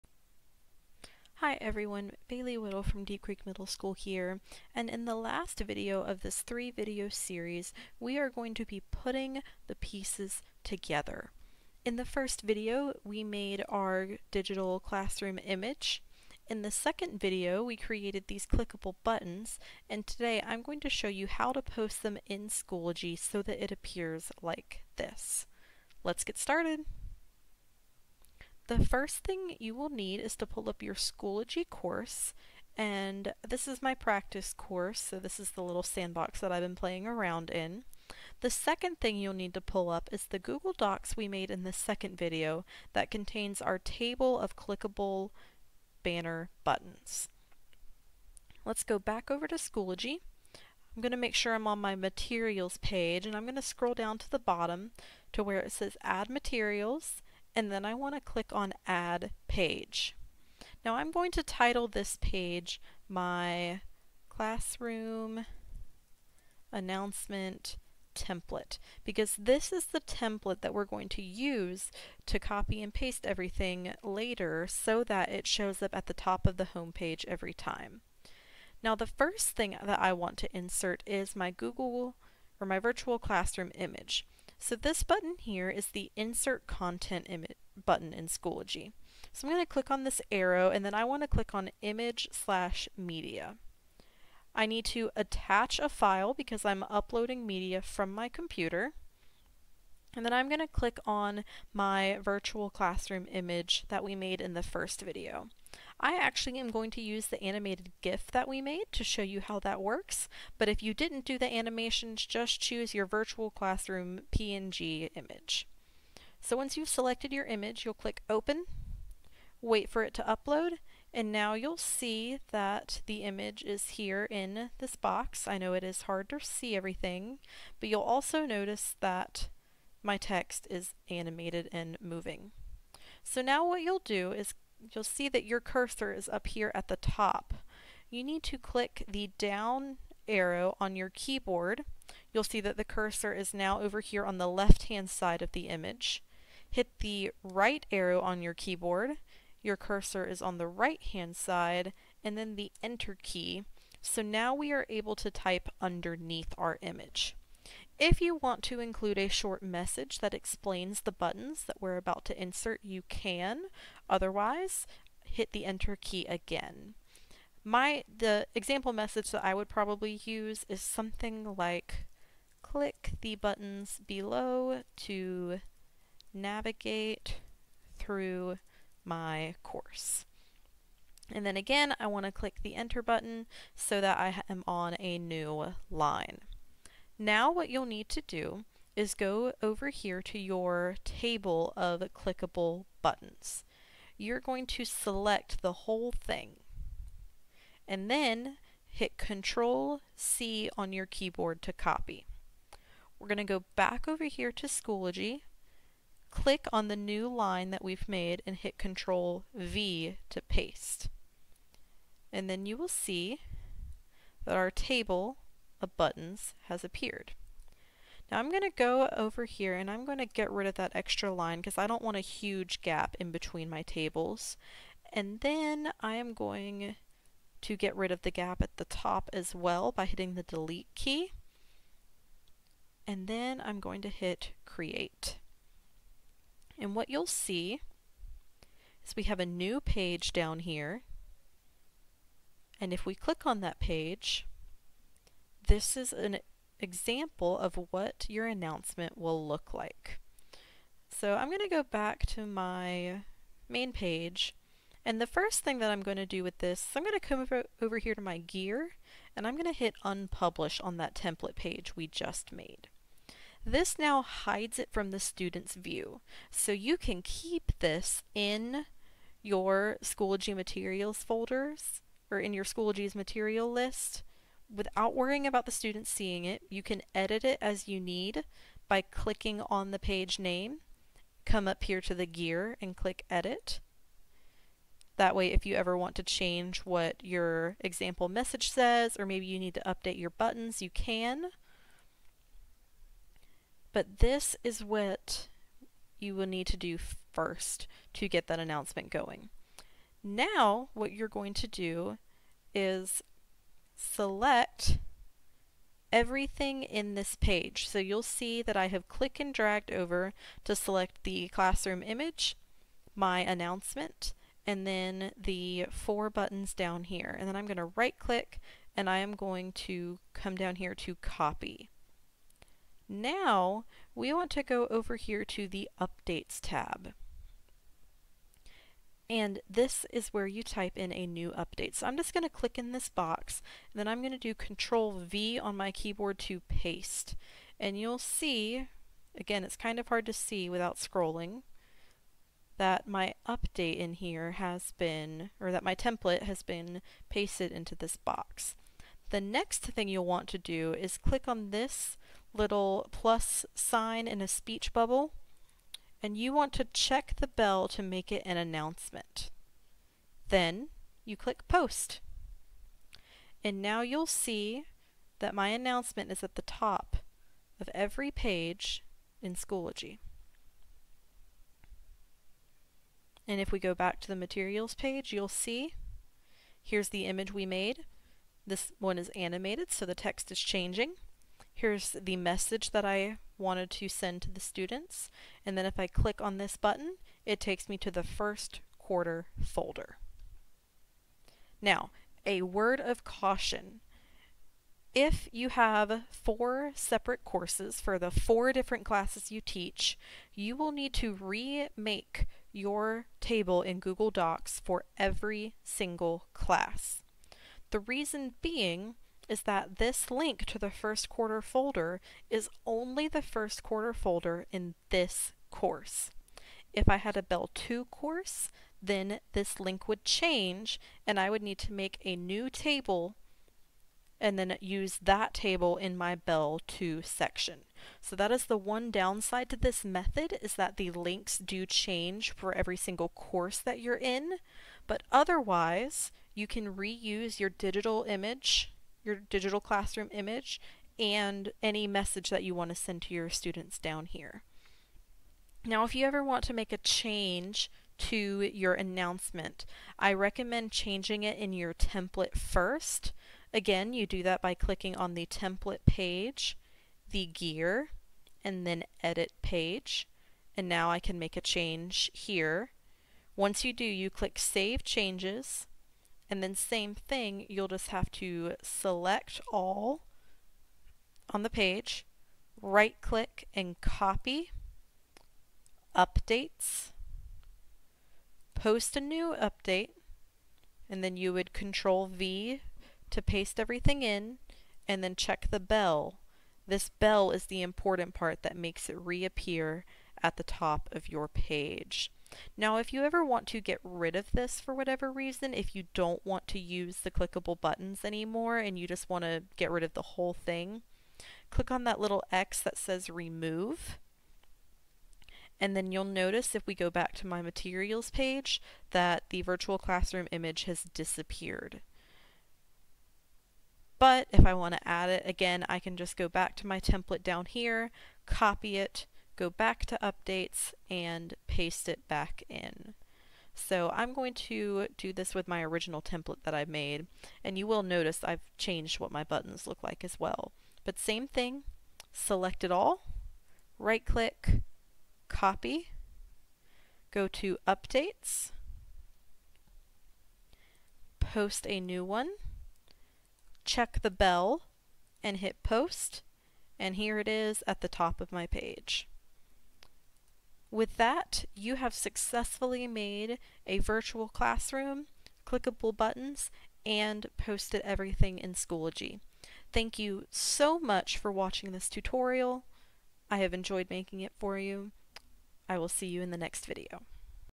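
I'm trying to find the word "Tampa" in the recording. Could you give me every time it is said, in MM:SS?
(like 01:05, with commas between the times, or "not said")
not said.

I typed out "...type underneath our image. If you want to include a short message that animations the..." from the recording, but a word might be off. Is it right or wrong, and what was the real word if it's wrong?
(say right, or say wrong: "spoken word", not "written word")
wrong: "explains", not "animations".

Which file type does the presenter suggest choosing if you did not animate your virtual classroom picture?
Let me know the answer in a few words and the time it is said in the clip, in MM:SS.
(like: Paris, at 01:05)
PNG, at 01:54.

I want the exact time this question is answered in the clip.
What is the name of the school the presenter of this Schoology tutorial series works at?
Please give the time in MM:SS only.
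00:03.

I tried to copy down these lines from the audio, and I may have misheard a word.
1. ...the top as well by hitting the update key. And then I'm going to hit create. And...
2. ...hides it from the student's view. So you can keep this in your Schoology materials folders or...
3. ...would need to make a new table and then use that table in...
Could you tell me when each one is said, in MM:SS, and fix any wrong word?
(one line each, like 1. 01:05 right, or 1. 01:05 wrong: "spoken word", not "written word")
1. 03:48 wrong: "delete", not "update"
2. 04:24 right
3. 07:01 right.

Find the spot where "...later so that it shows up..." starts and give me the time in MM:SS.
01:14.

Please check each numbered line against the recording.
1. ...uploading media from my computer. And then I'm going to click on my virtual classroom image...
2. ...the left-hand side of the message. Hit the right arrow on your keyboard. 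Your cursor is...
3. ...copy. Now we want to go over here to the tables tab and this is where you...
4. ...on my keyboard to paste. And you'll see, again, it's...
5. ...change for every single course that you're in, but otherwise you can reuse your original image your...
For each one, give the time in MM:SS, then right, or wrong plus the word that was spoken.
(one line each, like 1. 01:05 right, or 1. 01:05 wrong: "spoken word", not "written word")
1. 01:36 right
2. 02:24 wrong: "image", not "message"
3. 05:21 wrong: "updates", not "tables"
4. 05:35 right
5. 07:11 wrong: "digital", not "original".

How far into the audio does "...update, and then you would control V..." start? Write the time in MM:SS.
07:59.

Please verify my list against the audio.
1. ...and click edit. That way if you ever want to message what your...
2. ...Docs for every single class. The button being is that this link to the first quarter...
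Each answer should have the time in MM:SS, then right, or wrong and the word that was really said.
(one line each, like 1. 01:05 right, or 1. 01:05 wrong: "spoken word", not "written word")
1. 04:42 wrong: "change", not "message"
2. 06:44 wrong: "reason", not "button".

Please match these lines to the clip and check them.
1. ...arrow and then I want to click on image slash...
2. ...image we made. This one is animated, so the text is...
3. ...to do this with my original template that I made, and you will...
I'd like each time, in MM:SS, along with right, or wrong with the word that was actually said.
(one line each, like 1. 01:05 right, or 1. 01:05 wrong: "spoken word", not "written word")
1. 01:30 right
2. 06:17 right
3. 08:44 right.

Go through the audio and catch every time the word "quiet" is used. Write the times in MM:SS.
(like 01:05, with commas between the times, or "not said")
not said.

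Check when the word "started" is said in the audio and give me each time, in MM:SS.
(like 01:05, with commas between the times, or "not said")
00:26.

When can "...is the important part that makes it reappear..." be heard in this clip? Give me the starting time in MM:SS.
08:07.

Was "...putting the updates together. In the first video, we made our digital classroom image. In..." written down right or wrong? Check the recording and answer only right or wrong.
wrong.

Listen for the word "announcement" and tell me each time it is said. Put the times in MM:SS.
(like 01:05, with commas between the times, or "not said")
01:06, 04:08, 04:58, 05:13, 05:58, 06:05, 07:28.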